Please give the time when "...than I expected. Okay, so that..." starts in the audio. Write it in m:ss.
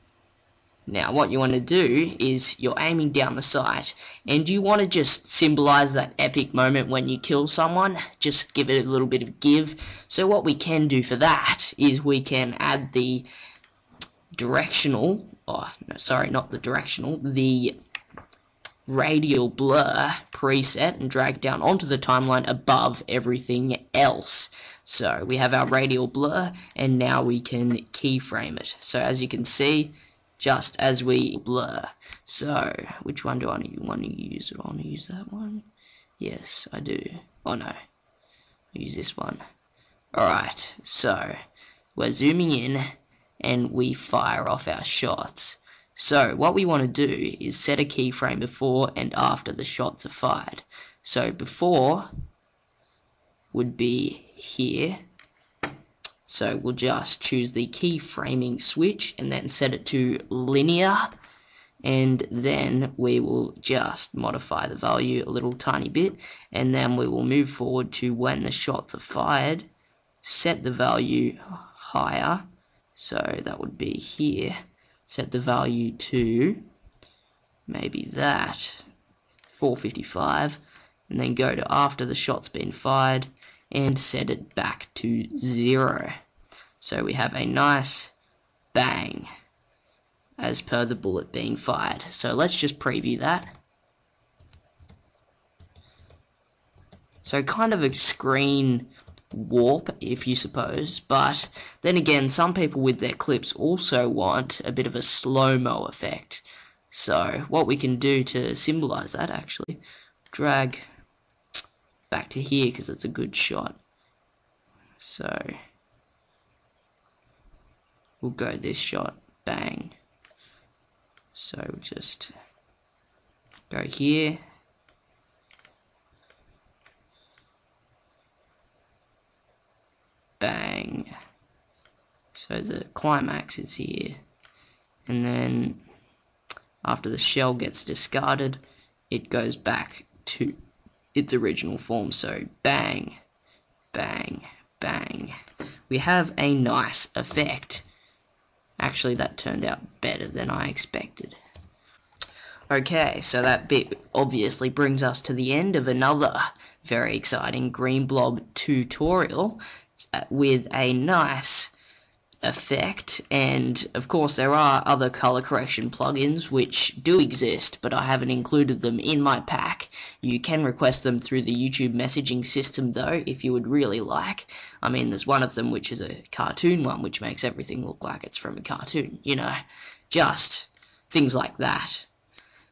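2:30.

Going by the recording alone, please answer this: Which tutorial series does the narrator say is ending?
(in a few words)
Green Blob.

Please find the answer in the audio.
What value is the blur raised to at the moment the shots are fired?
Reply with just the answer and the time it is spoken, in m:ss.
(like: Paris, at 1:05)
455, at 1:19.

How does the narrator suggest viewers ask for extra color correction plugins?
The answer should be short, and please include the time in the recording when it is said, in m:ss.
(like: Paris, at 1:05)
YouTube messaging system, at 2:51.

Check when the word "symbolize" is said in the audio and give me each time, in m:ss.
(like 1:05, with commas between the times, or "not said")
0:05, 1:48.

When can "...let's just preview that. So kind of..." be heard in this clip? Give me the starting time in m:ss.
1:32.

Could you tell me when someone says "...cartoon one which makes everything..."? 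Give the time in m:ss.
2:56.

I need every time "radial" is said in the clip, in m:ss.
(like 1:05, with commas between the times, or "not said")
0:18, 0:25.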